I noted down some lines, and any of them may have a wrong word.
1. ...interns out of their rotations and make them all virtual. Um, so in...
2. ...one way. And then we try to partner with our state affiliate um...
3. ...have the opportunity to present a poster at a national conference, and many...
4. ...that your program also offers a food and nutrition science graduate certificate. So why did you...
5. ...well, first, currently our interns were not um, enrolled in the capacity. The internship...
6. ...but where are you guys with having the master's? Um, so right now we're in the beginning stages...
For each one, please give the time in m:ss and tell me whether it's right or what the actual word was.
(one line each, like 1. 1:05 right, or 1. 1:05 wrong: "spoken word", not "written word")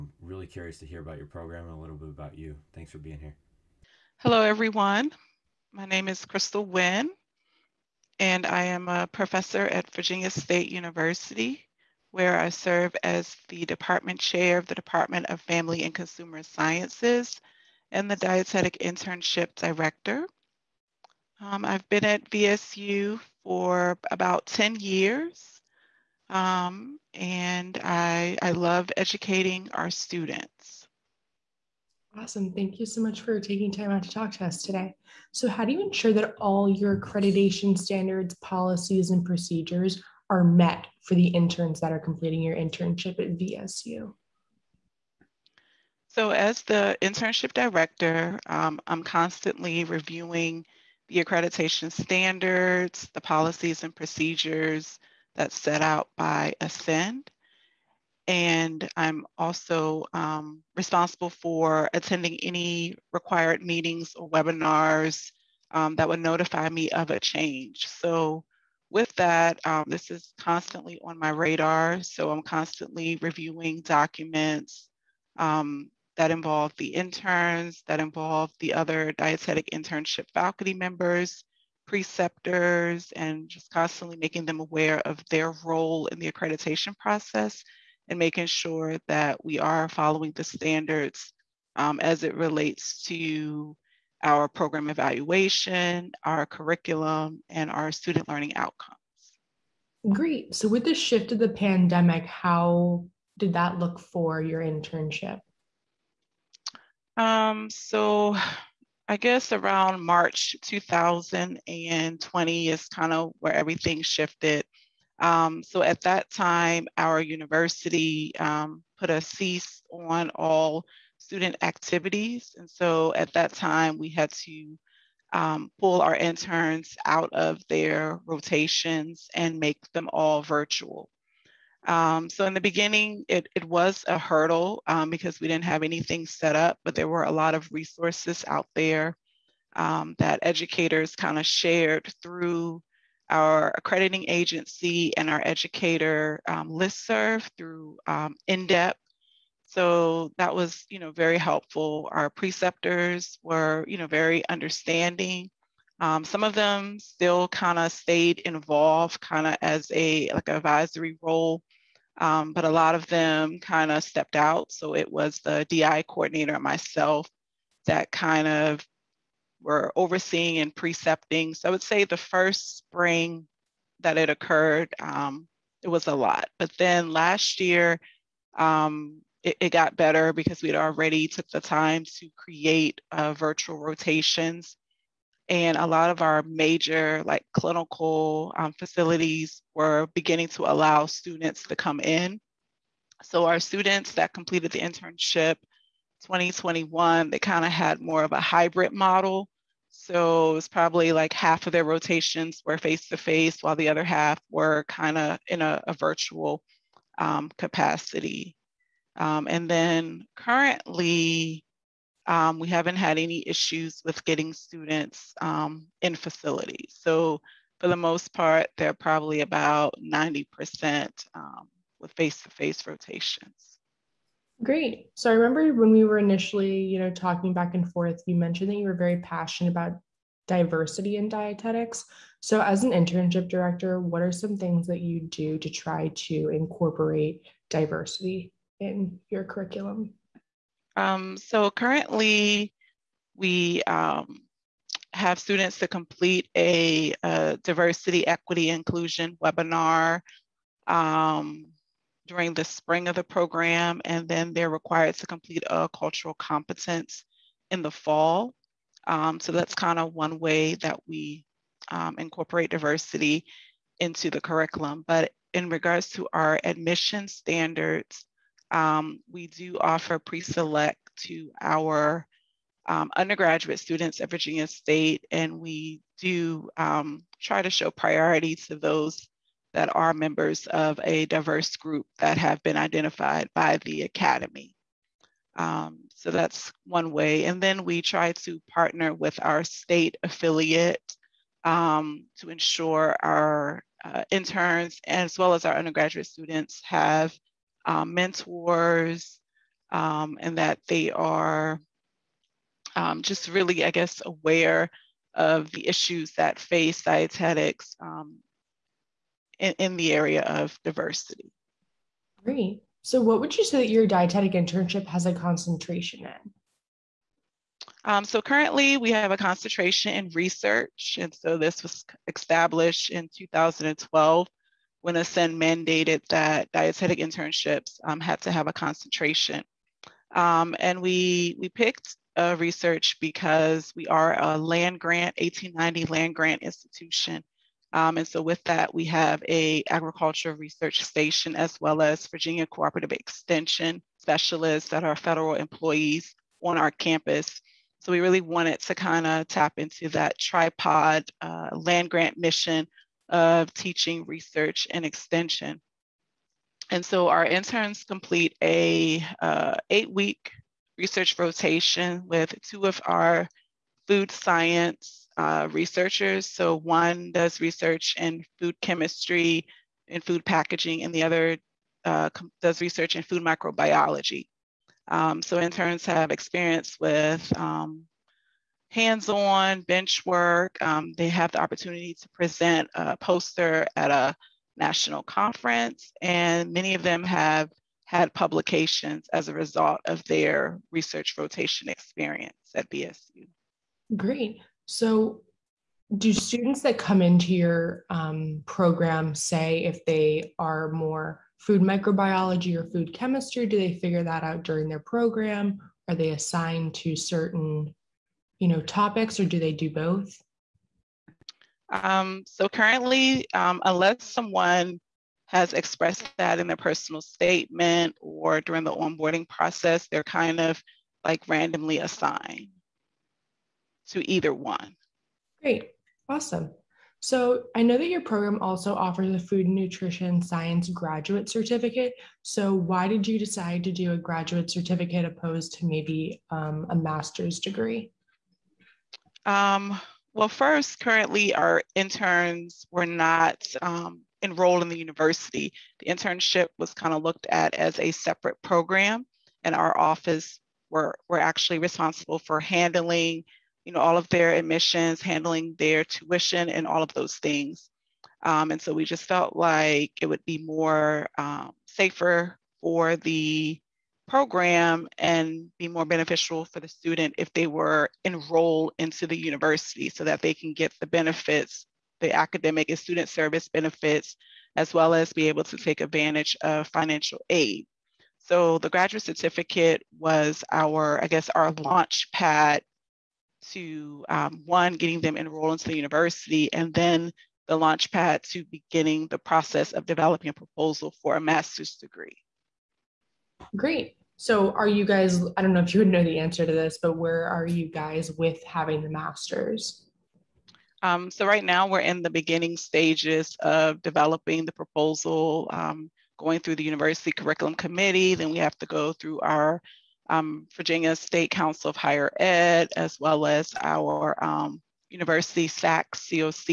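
1. 2:06 right
2. 4:46 right
3. 6:21 right
4. 7:07 right
5. 7:20 wrong: "university", not "capacity"
6. 8:17 right.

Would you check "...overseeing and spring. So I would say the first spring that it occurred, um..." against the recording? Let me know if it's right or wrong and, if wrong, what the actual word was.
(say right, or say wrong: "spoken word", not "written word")
wrong: "precepting", not "spring".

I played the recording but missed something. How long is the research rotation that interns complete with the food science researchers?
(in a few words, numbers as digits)
8 weeks.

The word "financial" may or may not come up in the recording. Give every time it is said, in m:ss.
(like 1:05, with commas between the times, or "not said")
7:56.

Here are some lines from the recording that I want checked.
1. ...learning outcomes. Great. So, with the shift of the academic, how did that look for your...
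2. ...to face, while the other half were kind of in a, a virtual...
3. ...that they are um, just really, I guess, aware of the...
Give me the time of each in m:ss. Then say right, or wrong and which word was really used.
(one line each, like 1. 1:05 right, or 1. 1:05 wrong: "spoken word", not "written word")
1. 1:38 wrong: "pandemic", not "academic"
2. 3:23 right
3. 5:00 right.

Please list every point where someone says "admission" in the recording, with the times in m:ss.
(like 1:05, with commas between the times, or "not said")
4:26, 7:34.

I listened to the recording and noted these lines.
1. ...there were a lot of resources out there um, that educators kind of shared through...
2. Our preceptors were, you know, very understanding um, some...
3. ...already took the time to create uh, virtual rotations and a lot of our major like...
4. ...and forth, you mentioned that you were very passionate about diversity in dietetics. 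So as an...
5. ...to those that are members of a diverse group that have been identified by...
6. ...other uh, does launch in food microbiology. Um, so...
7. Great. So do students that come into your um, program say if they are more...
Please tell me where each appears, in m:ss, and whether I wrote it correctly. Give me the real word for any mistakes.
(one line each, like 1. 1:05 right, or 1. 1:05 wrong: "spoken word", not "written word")
1. 2:16 right
2. 2:32 right
3. 3:00 right
4. 3:47 right
5. 4:38 right
6. 6:11 wrong: "research", not "launch"
7. 6:34 right.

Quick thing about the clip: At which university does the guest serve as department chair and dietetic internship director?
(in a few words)
Virginia State University.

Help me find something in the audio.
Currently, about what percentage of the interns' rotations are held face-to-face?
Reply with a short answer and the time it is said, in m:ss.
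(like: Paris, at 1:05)
90%, at 3:40.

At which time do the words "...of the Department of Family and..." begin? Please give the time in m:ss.
0:14.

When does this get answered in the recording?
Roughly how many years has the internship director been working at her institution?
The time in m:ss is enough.
0:24.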